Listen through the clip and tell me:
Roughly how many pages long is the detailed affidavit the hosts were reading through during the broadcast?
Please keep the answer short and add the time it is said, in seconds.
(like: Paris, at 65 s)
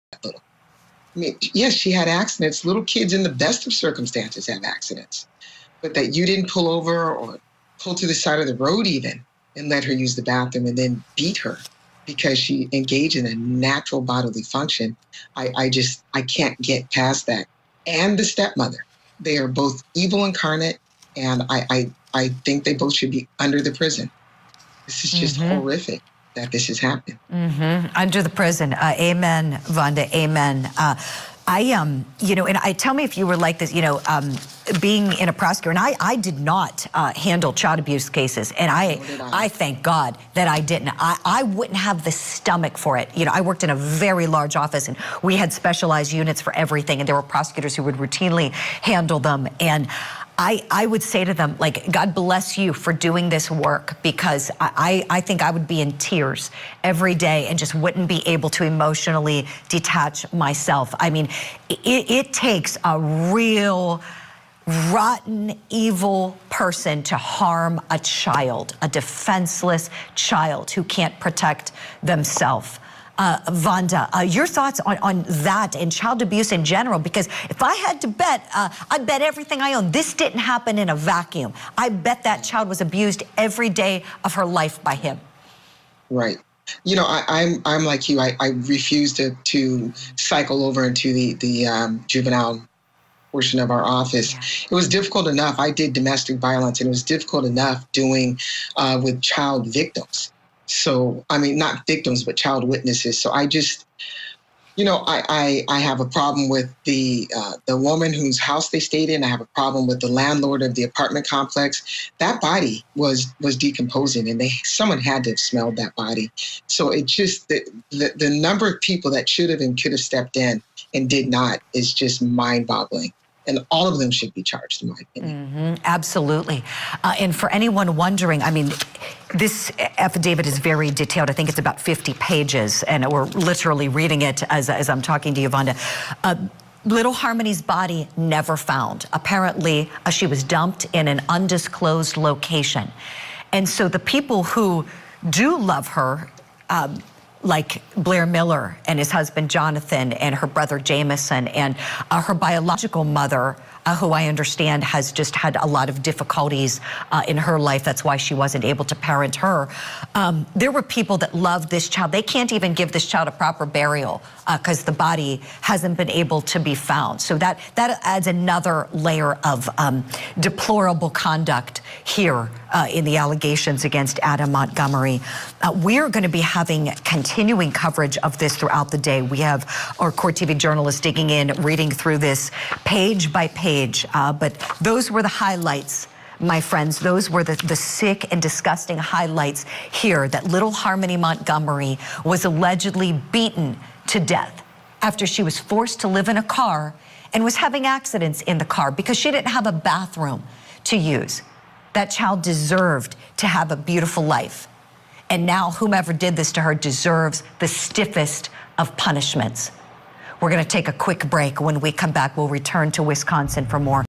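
50, at 131 s.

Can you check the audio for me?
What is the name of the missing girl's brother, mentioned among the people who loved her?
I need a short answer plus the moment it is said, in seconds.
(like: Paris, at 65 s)
Jamison, at 150 s.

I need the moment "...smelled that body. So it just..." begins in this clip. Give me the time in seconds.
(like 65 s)
115 s.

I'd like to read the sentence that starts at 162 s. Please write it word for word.
They can't even give this child a proper burial because uh, the body hasn't been able to be found.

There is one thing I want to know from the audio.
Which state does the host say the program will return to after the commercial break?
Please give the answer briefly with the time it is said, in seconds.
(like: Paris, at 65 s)
Wisconsin, at 213 s.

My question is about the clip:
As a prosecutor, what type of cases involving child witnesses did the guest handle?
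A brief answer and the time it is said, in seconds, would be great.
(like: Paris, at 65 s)
Domestic violence, at 95 s.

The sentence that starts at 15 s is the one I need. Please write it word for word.
I, I just, I can't get past that.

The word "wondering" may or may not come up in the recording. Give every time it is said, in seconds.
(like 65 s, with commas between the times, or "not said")
127 s.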